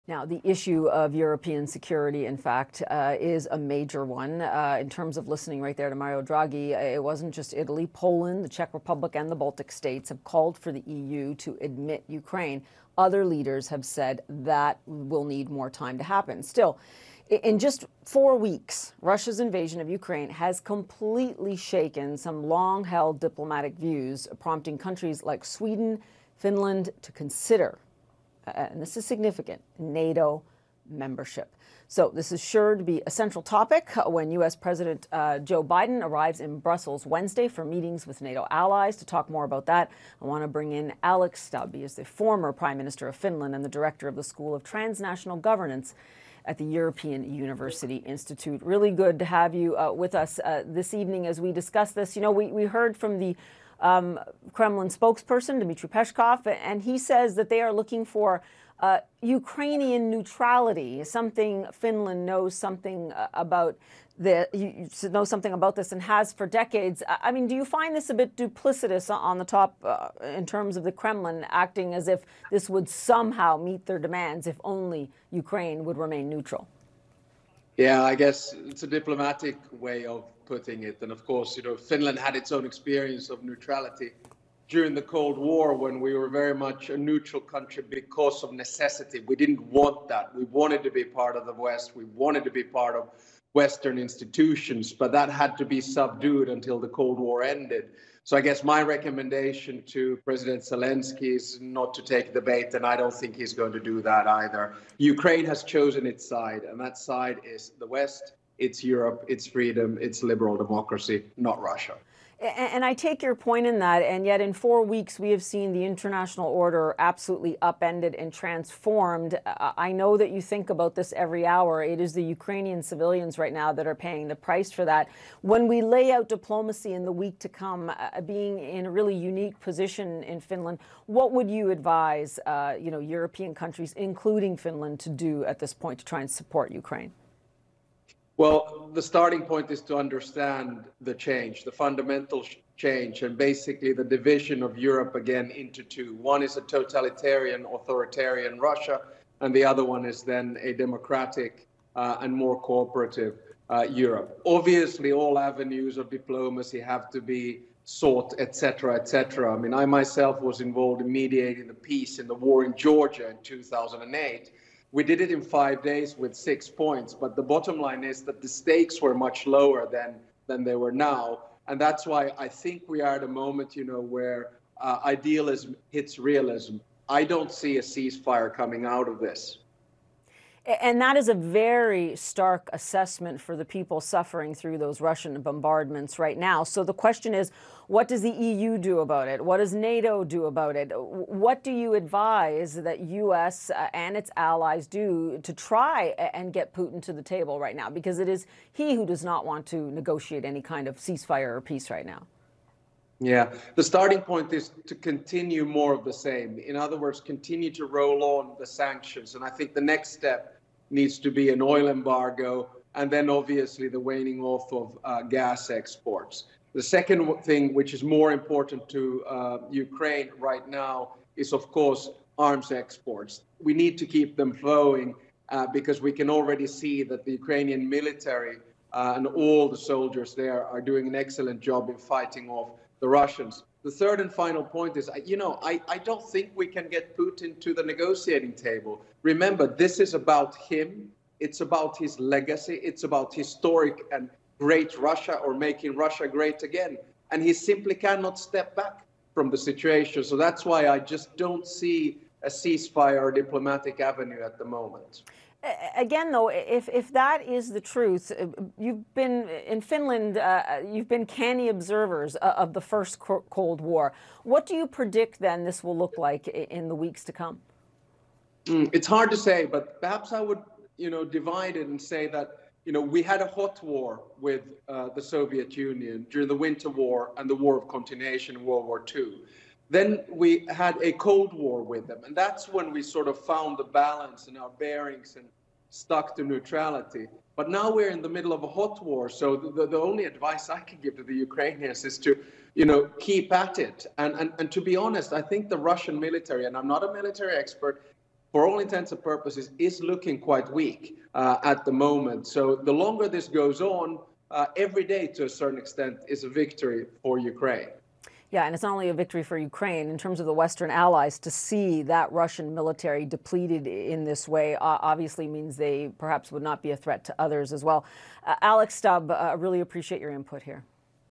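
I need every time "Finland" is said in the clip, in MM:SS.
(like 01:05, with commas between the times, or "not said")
00:26, 00:43, 01:01, 01:21, 02:10, 02:14, 04:19.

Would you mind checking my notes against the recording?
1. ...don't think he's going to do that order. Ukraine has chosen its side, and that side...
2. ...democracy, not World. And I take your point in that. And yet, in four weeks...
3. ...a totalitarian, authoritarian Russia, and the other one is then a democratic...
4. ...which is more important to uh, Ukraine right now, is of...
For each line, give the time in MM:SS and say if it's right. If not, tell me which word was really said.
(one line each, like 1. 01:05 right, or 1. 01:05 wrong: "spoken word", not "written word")
1. 01:42 wrong: "either", not "order"
2. 01:50 wrong: "Russia", not "World"
3. 02:26 right
4. 03:37 right.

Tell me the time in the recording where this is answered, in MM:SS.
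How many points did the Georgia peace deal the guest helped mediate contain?
02:46.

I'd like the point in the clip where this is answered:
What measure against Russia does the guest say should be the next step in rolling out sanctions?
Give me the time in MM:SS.
03:31.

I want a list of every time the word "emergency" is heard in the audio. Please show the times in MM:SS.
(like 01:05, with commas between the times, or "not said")
not said.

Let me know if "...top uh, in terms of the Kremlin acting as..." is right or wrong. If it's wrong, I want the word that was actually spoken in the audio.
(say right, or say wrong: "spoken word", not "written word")
right.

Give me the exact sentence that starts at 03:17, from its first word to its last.
Because it is he who does not want to negotiate any kind of ceasefire or peace right now.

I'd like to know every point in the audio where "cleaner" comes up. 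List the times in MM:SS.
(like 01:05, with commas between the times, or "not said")
not said.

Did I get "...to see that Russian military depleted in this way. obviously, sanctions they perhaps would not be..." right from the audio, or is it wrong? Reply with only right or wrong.
wrong.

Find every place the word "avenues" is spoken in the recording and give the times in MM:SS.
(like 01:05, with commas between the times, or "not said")
02:35, 04:13.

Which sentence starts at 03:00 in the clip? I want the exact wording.
And that is a very stark assessment for the people suffering through those Russian bombardments right now.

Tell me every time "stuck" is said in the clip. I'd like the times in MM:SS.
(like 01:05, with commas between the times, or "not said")
04:45.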